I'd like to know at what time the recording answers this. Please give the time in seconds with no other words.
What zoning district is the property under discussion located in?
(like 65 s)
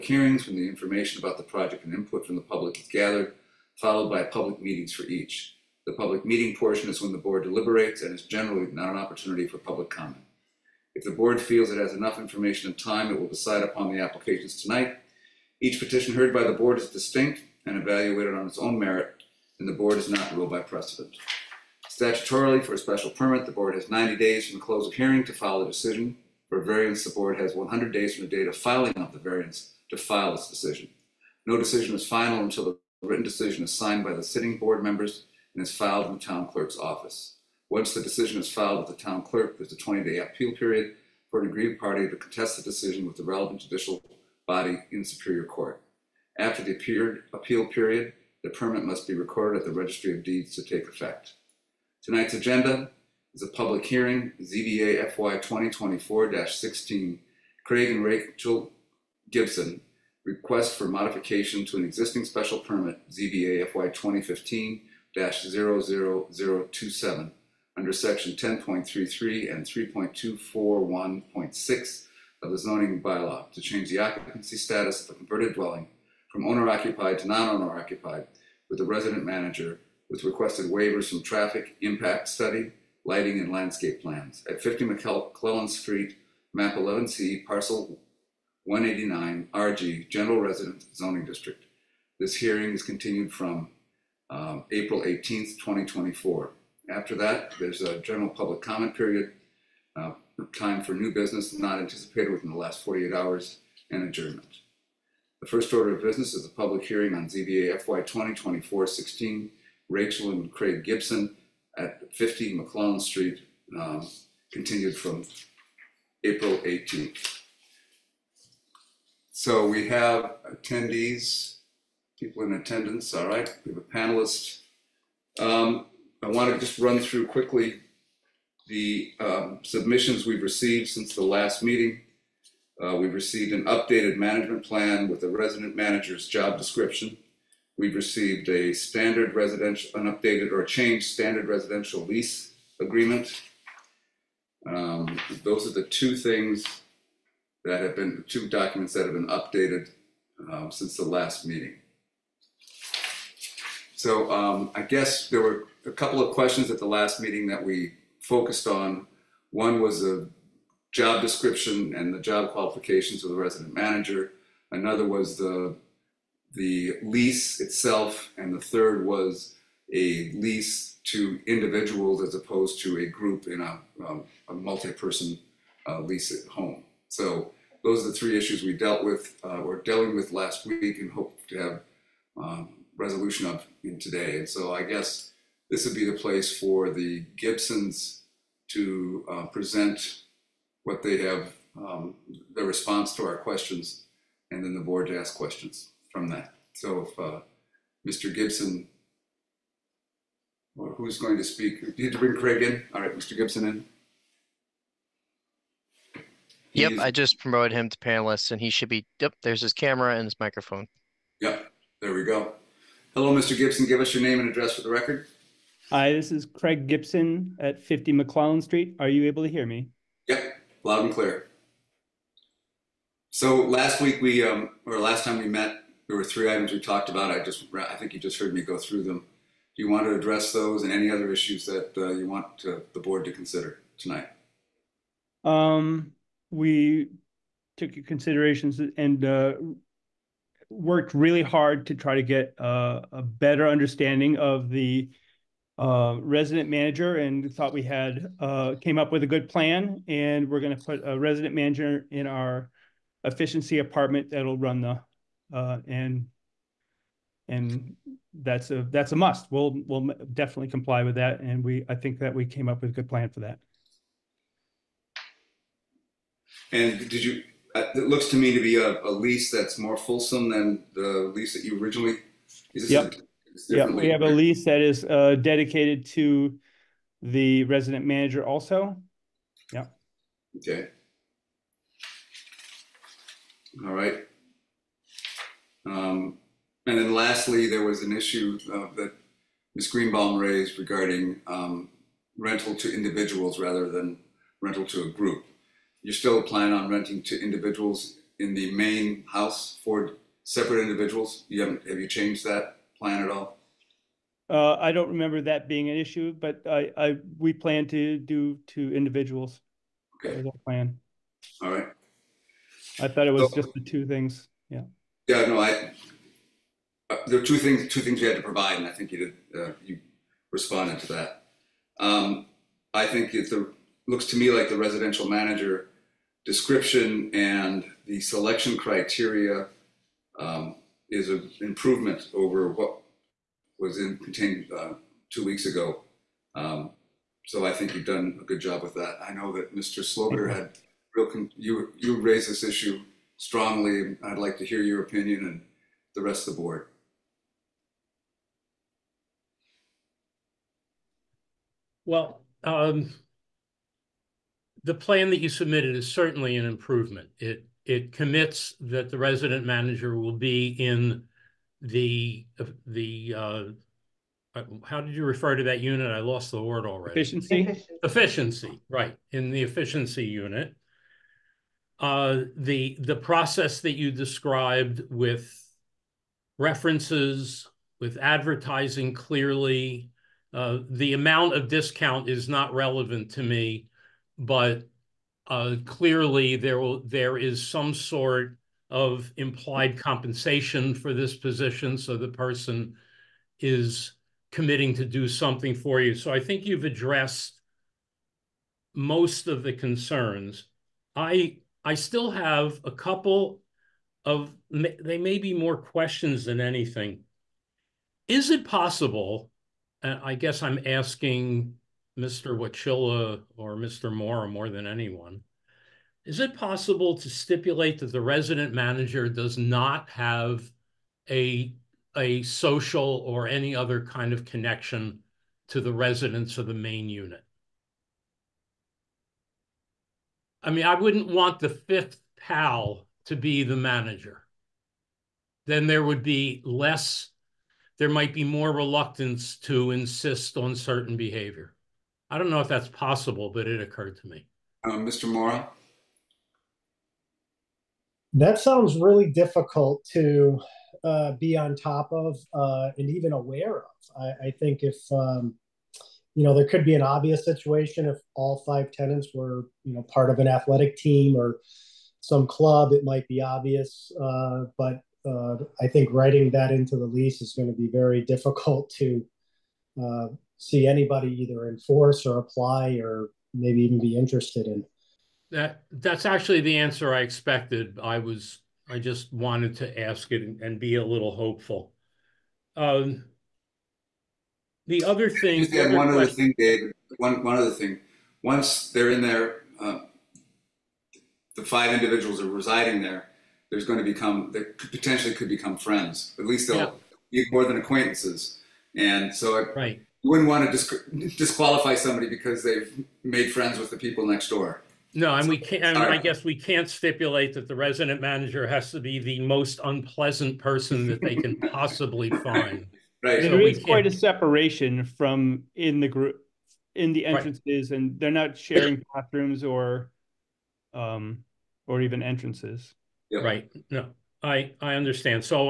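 90 s.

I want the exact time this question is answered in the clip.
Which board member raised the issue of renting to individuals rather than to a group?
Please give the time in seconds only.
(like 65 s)
289 s.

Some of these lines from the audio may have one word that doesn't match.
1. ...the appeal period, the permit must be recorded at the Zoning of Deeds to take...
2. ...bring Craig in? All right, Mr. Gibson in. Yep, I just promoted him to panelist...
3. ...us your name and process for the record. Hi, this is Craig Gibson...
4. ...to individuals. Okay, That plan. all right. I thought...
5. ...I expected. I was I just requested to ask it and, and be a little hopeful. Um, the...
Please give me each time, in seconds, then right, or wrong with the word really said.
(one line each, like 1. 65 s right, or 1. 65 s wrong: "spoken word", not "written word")
1. 46 s wrong: "Registry", not "Zoning"
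2. 202 s right
3. 213 s wrong: "address", not "process"
4. 308 s right
5. 477 s wrong: "wanted", not "requested".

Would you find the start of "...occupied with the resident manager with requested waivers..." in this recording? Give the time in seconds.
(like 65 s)
77 s.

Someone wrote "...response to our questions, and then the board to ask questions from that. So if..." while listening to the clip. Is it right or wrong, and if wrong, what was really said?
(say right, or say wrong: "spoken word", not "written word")
right.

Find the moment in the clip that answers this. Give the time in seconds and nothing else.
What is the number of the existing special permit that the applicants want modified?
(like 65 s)
63 s.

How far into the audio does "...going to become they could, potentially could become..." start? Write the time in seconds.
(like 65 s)
493 s.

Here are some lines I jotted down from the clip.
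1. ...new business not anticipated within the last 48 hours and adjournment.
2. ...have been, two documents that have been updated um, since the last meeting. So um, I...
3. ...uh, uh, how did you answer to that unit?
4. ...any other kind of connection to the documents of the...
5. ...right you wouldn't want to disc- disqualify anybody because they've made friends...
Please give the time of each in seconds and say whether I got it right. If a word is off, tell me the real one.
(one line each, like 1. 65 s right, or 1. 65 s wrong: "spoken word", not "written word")
1. 100 s right
2. 147 s right
3. 363 s wrong: "refer", not "answer"
4. 423 s wrong: "residents", not "documents"
5. 499 s wrong: "somebody", not "anybody".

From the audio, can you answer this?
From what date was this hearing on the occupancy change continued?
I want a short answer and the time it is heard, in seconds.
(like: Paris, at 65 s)
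April 18th, 2024, at 94 s.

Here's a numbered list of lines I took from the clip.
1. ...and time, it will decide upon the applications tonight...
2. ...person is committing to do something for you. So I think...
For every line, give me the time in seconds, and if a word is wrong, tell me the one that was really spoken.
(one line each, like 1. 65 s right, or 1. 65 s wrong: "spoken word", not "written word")
1. 12 s right
2. 392 s right.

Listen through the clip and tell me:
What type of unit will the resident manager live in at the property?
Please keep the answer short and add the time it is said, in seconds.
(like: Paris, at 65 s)
efficiency apartment, at 253 s.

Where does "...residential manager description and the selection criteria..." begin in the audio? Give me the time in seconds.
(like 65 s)
324 s.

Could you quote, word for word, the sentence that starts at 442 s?
I don't know if that's possible, but it occurred to me.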